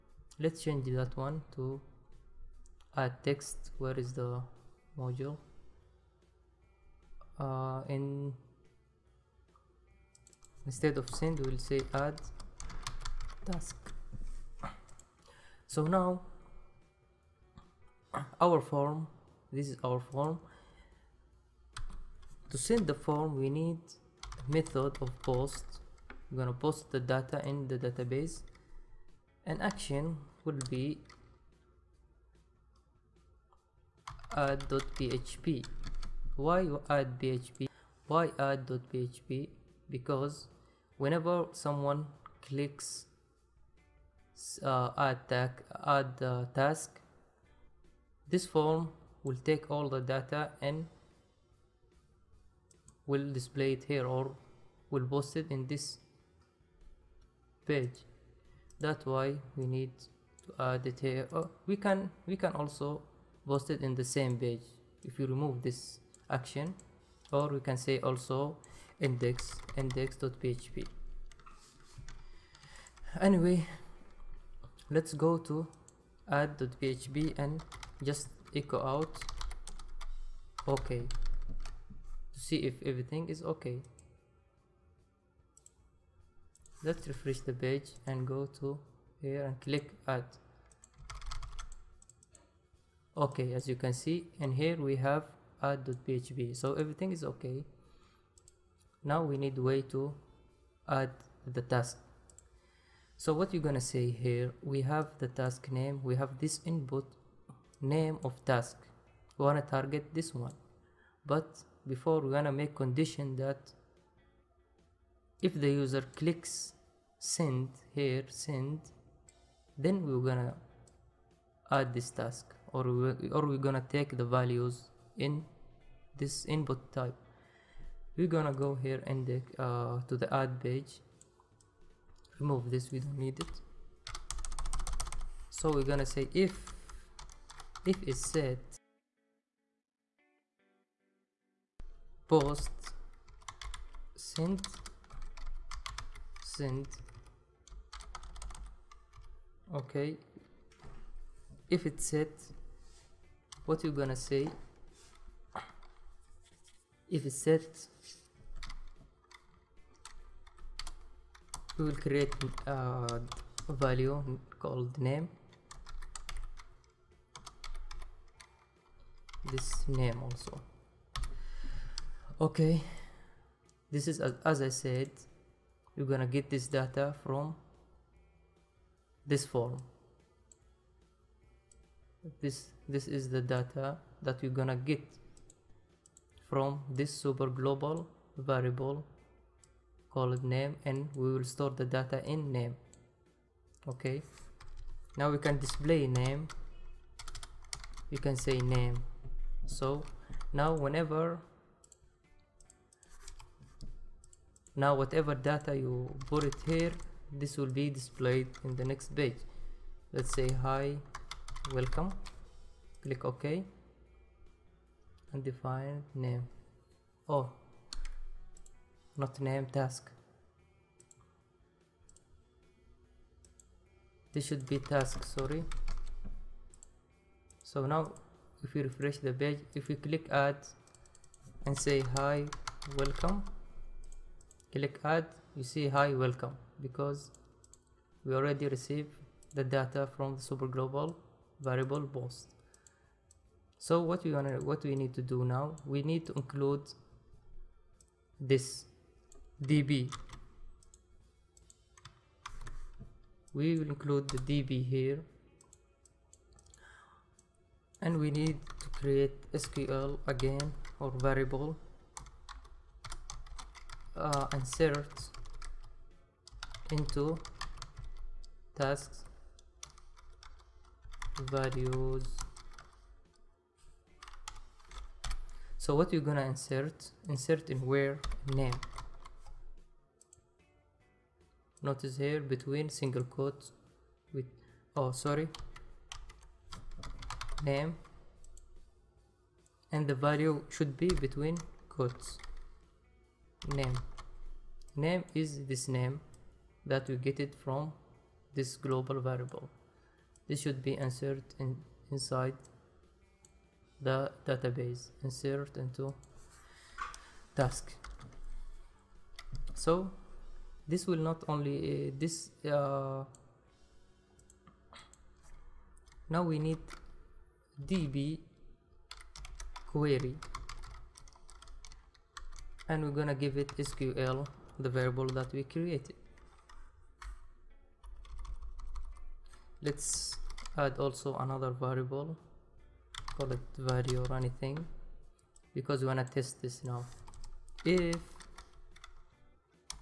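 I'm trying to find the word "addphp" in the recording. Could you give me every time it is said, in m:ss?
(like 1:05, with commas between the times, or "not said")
0:34, 0:38, 1:16, 1:35.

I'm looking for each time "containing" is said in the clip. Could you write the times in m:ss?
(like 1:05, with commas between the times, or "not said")
not said.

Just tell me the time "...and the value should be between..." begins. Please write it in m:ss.
4:49.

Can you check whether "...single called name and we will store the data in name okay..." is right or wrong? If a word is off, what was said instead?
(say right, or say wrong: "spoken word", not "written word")
wrong: "variable", not "single".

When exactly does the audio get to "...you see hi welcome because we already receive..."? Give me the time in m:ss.
3:55.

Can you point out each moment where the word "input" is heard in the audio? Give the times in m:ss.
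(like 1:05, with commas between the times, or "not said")
1:46, 2:06.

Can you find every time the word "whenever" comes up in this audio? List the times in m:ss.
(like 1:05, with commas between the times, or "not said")
0:40, 3:20.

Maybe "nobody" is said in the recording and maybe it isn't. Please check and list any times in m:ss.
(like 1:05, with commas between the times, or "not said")
not said.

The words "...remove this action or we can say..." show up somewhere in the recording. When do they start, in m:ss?
1:05.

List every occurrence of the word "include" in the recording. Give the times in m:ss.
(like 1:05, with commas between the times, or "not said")
4:06, 4:13.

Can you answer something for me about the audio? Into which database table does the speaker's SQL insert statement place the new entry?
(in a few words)
tasks.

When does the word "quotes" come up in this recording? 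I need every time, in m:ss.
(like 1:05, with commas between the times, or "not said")
4:43, 4:51.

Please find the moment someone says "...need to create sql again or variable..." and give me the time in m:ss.
4:18.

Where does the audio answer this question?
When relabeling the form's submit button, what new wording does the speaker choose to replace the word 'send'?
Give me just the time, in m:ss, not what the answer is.
0:11.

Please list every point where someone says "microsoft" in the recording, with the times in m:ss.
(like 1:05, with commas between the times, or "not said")
not said.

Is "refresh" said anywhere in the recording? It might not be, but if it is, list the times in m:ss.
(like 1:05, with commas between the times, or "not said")
1:27, 3:48.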